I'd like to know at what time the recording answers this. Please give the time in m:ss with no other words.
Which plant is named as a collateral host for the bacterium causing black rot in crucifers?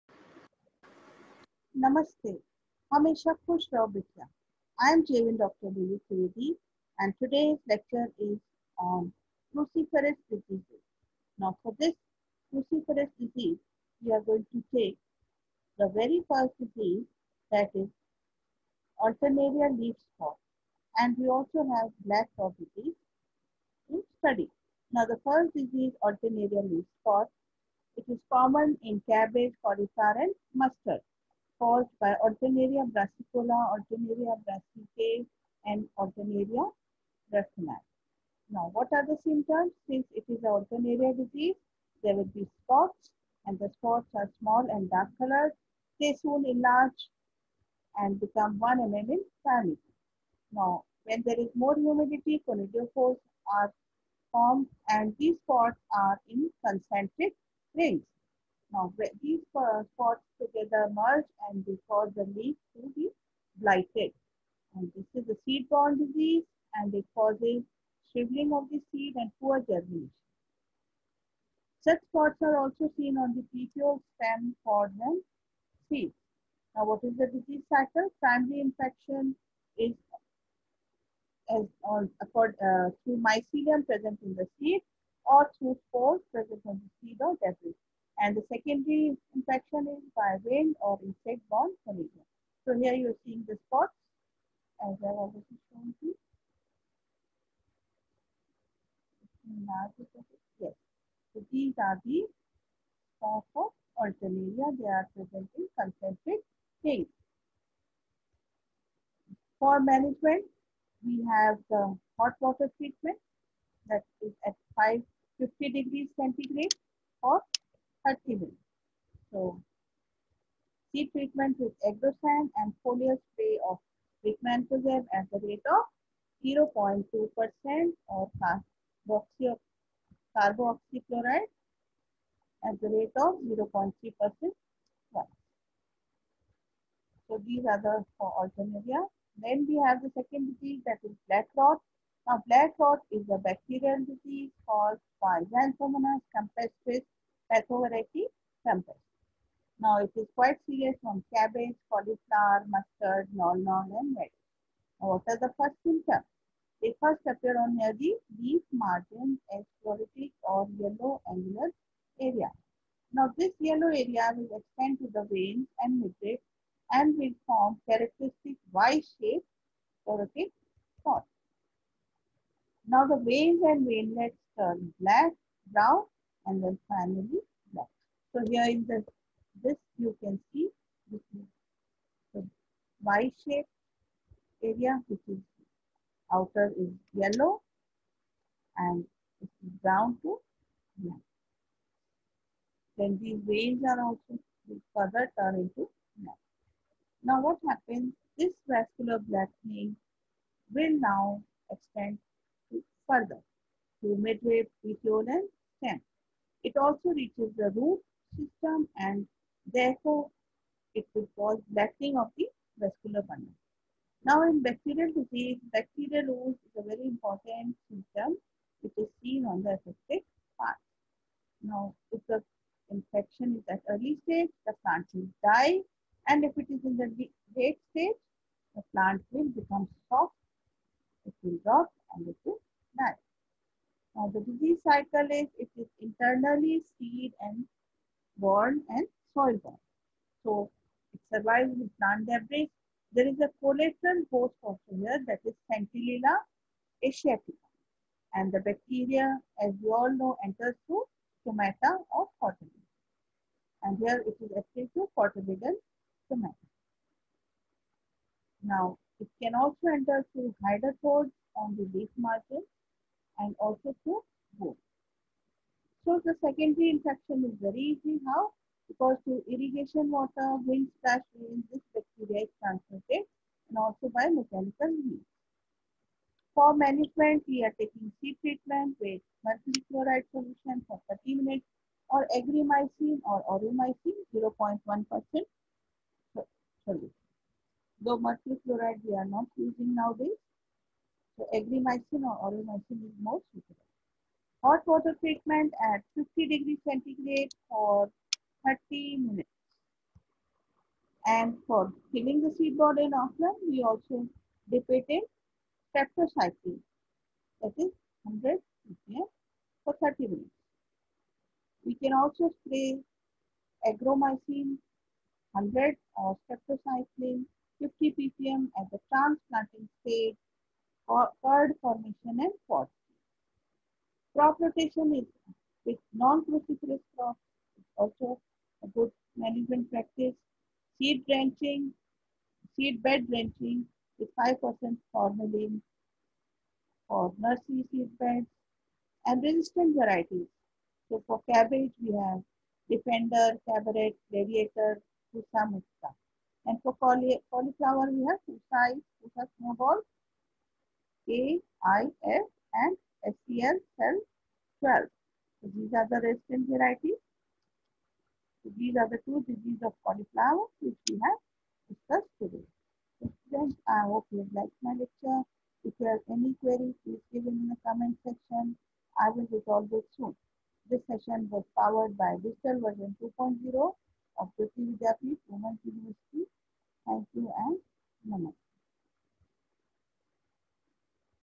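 4:05.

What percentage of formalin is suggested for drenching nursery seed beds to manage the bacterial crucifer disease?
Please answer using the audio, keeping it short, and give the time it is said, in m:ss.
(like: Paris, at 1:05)
5%, at 5:34.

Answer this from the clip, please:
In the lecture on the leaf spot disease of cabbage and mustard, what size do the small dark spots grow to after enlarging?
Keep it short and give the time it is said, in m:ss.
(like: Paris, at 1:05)
1 mm, at 0:48.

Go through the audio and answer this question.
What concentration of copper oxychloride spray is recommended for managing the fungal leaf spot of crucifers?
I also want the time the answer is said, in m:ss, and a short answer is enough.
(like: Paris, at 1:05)
0.3%, at 2:13.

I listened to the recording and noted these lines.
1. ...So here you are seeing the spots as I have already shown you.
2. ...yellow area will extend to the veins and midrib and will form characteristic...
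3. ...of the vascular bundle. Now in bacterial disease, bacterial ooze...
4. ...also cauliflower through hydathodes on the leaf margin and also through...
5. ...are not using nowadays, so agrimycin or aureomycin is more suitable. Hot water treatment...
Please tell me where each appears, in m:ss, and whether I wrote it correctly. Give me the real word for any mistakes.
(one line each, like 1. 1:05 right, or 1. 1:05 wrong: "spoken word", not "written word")
1. 1:31 right
2. 2:43 right
3. 3:32 right
4. 4:19 wrong: "enter", not "cauliflower"
5. 4:49 right.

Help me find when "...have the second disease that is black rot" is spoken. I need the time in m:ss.
2:19.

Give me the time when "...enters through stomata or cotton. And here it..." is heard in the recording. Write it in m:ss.
4:10.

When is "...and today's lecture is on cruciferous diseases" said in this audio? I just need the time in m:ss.
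0:06.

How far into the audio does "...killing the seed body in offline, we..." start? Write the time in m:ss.
5:02.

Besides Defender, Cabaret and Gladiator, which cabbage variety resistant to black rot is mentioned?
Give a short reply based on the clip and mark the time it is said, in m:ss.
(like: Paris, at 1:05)
Pusa Mukta, at 5:45.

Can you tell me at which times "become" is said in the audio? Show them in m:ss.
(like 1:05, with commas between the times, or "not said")
0:48, 3:49.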